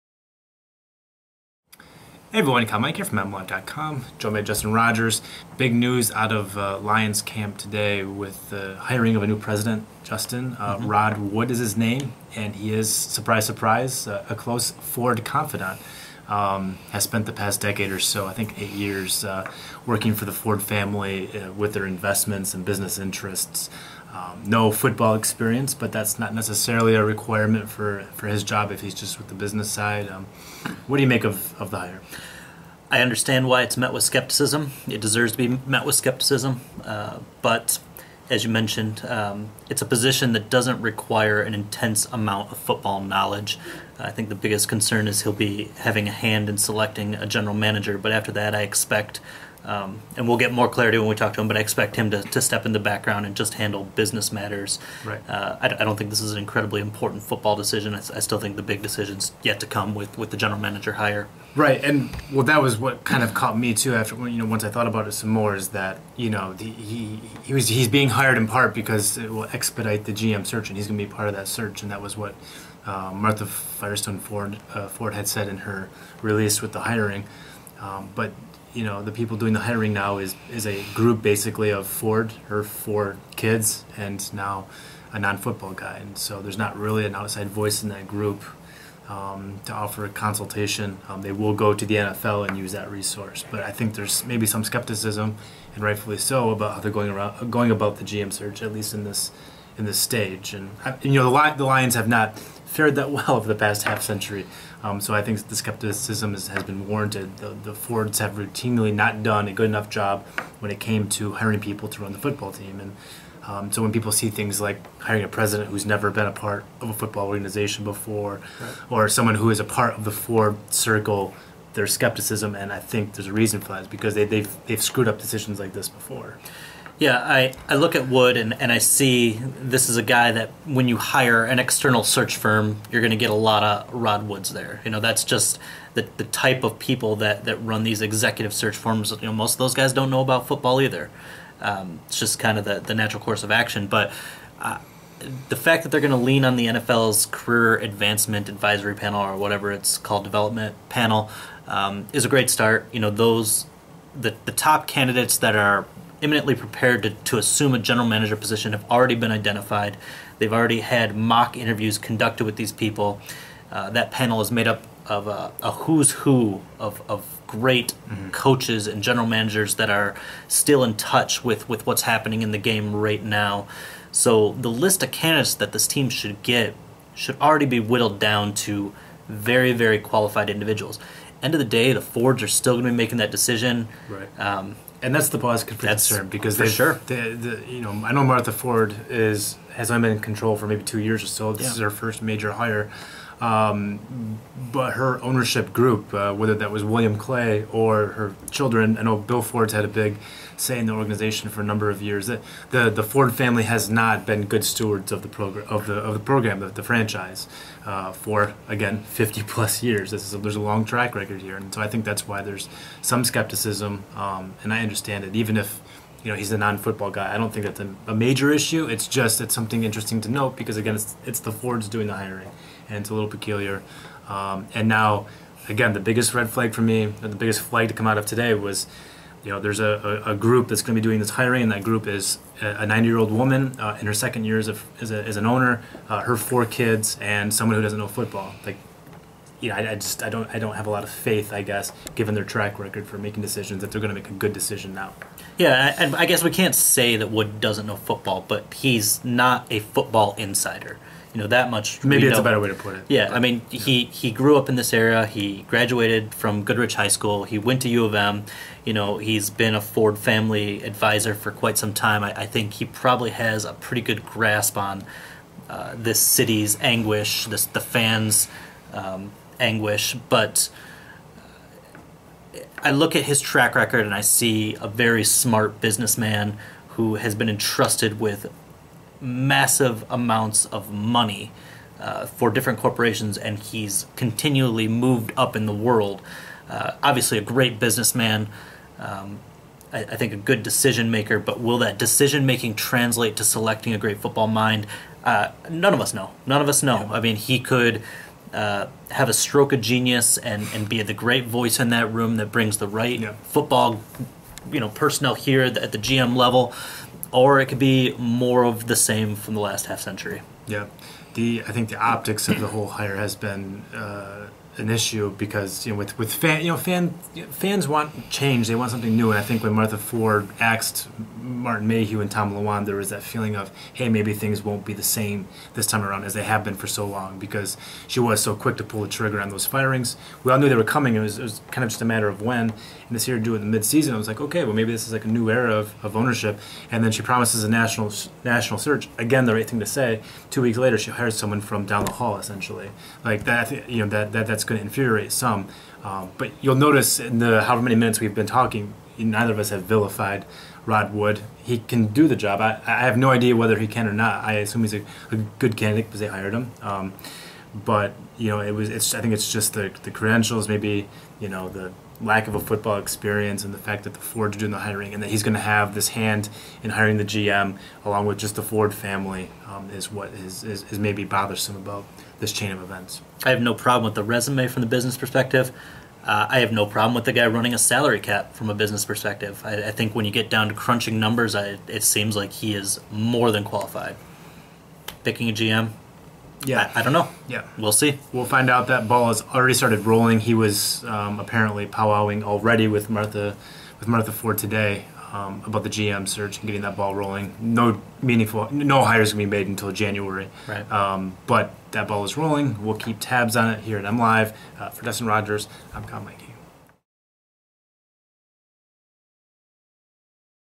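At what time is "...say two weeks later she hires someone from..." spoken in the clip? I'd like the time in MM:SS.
05:39.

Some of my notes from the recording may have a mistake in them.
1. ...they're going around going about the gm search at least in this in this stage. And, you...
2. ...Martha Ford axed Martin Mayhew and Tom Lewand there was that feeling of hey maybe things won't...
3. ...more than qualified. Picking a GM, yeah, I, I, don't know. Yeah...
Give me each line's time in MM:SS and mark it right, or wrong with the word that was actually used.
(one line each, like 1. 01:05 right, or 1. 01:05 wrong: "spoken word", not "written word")
1. 01:36 right
2. 05:19 right
3. 06:23 right.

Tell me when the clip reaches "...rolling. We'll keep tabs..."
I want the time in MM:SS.
06:42.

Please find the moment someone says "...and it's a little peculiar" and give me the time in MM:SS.
03:42.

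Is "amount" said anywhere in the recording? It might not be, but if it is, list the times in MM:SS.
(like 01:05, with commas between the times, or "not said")
00:42, 04:40.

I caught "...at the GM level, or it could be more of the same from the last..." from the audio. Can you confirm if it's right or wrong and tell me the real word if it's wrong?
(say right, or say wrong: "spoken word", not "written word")
right.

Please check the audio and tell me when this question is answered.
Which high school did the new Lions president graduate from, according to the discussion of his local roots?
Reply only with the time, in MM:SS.
04:16.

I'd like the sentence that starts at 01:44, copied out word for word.
Um, so I think the skepticism is, has been warranted.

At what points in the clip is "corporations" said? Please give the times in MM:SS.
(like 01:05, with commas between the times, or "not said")
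04:42.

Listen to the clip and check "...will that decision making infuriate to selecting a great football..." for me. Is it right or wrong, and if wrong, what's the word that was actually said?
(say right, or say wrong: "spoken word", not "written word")
wrong: "translate", not "infuriate".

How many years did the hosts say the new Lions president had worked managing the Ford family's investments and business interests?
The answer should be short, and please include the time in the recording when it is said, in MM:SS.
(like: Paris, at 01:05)
8, at 00:18.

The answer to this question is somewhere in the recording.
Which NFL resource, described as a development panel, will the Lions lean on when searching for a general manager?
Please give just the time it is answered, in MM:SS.
02:27.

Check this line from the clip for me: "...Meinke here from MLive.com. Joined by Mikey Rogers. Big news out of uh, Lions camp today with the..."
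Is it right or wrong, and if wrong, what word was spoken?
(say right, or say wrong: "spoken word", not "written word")
wrong: "Justin", not "Mikey".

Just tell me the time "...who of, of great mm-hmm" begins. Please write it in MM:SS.
02:46.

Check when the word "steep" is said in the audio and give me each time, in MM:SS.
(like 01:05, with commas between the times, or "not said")
not said.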